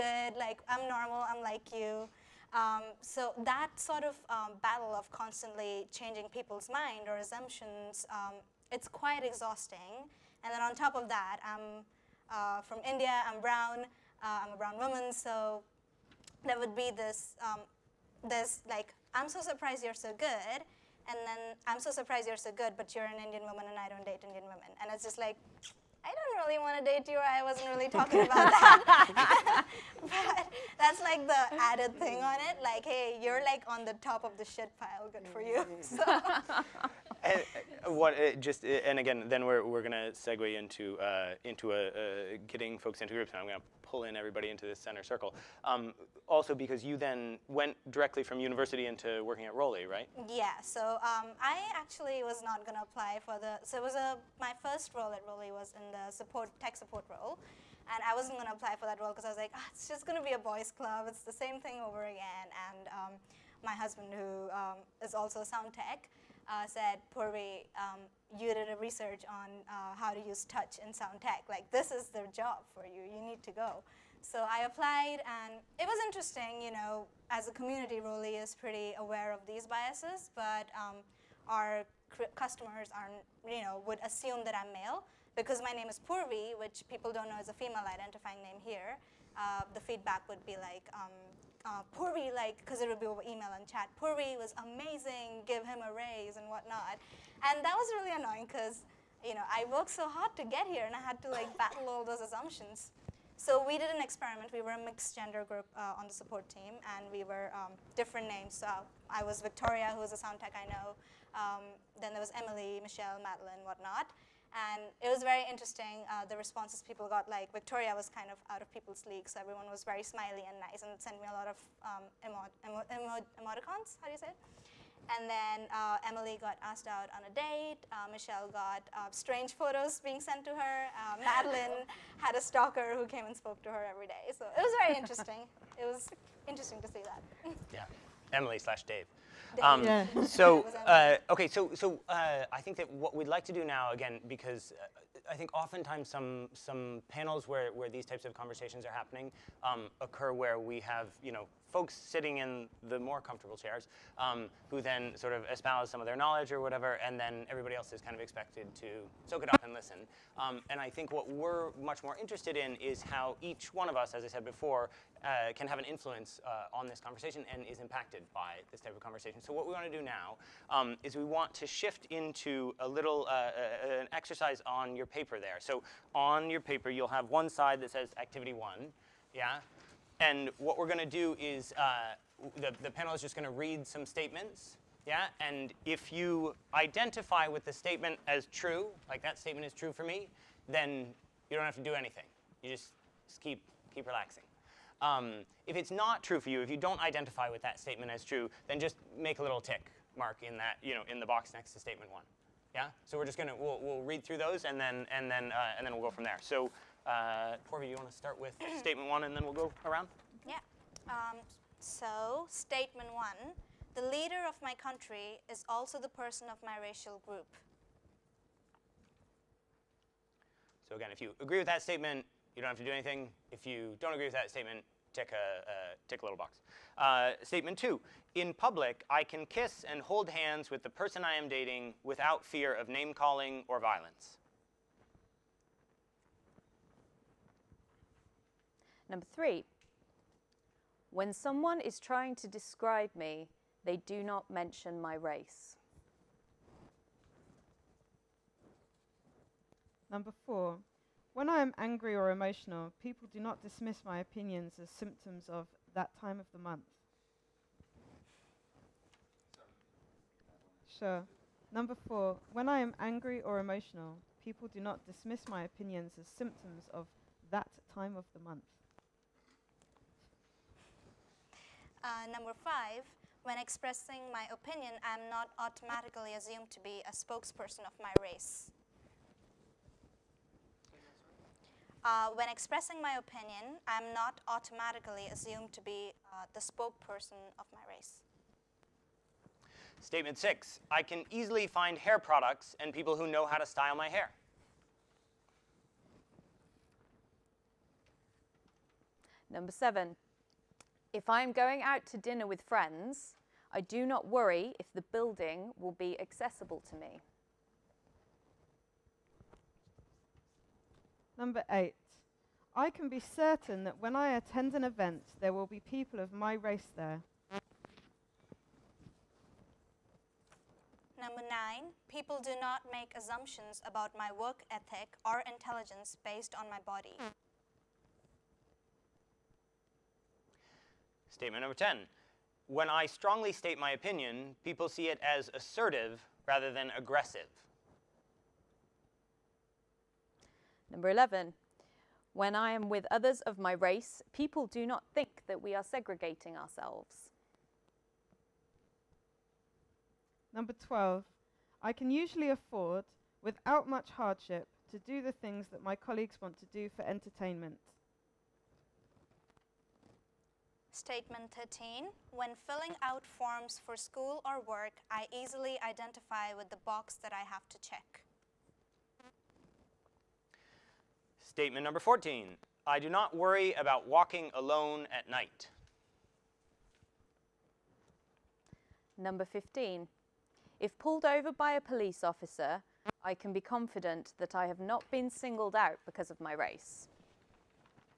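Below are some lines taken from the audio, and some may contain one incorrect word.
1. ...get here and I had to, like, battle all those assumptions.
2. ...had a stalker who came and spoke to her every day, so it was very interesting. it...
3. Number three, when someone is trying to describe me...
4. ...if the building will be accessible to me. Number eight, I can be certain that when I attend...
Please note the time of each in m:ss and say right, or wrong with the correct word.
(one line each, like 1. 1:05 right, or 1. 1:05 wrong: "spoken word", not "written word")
1. 1:40 right
2. 2:12 right
3. 3:59 right
4. 5:04 right.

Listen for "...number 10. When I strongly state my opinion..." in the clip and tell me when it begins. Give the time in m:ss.
5:31.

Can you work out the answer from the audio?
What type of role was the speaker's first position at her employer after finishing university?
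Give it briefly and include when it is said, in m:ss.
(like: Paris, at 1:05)
tech support, at 0:56.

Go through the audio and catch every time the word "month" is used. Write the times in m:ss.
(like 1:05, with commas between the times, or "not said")
4:16, 4:28.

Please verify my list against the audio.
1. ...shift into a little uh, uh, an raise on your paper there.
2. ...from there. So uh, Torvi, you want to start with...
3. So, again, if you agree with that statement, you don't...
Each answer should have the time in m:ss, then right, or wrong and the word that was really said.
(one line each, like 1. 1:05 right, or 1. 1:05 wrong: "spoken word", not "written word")
1. 2:51 wrong: "exercise", not "raise"
2. 3:26 right
3. 3:40 right.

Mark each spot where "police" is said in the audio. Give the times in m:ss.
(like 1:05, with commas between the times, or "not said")
6:21.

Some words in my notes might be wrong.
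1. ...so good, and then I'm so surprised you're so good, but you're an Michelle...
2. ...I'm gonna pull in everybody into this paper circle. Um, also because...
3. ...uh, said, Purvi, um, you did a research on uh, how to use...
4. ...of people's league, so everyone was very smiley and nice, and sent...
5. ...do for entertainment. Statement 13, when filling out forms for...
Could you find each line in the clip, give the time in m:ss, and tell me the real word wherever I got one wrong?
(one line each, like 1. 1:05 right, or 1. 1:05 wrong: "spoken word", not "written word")
1. 0:19 wrong: "Indian", not "Michelle"
2. 0:43 wrong: "center", not "paper"
3. 1:06 right
4. 1:58 right
5. 5:56 right.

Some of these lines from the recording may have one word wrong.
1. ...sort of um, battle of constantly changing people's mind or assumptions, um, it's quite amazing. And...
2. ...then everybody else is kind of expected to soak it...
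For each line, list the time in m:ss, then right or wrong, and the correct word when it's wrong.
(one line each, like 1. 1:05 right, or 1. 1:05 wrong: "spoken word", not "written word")
1. 0:03 wrong: "exhausting", not "amazing"
2. 2:37 right.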